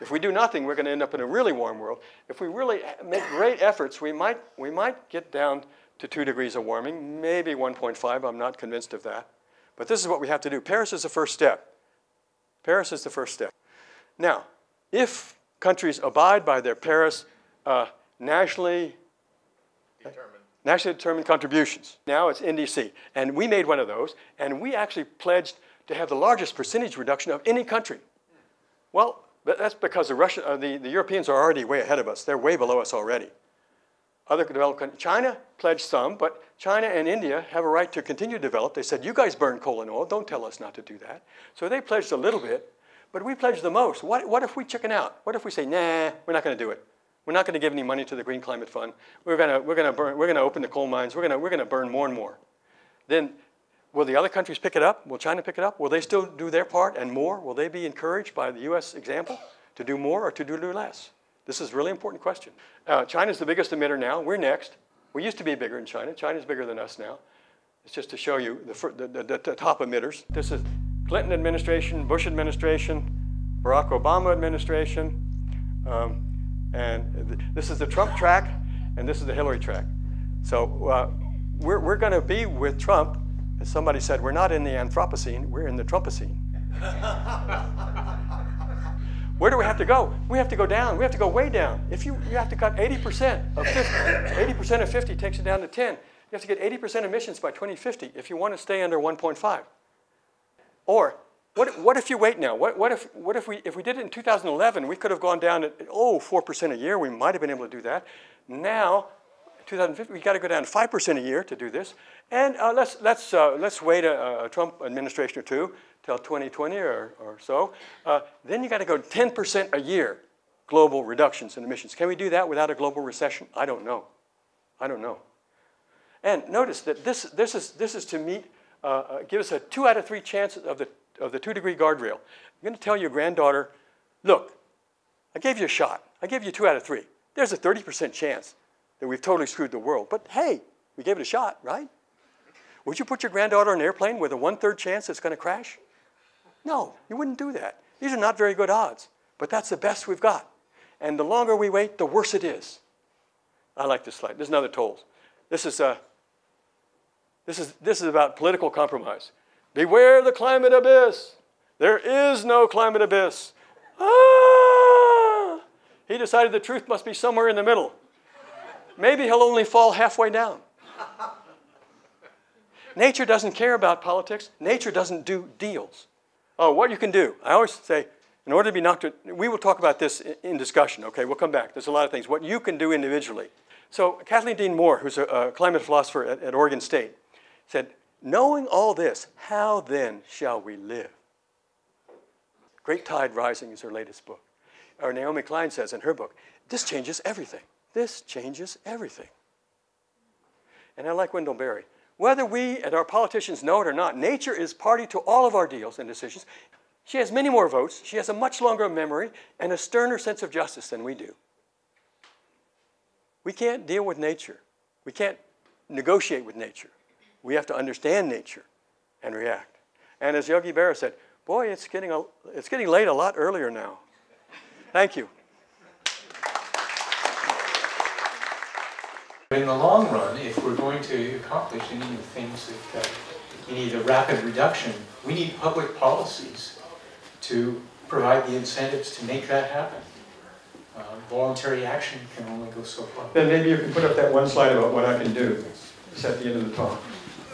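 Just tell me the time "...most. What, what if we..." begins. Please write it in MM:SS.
00:43.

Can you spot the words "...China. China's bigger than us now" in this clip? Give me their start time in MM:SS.
01:05.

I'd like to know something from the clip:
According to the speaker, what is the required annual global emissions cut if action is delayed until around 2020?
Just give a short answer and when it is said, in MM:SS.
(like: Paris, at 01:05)
10%, at 01:58.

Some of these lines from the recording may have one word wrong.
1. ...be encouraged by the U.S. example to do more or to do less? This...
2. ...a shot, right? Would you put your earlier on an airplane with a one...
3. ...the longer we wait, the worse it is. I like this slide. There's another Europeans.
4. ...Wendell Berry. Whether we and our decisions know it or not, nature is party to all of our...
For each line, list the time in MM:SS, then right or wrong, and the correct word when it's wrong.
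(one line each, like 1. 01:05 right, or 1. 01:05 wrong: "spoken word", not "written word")
1. 00:57 right
2. 02:21 wrong: "granddaughter", not "earlier"
3. 02:31 wrong: "Toles", not "Europeans"
4. 03:21 wrong: "politicians", not "decisions".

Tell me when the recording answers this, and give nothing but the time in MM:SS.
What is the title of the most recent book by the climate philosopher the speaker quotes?
03:12.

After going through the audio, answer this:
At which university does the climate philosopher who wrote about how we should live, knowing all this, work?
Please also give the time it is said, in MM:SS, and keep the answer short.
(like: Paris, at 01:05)
Oregon State, at 03:06.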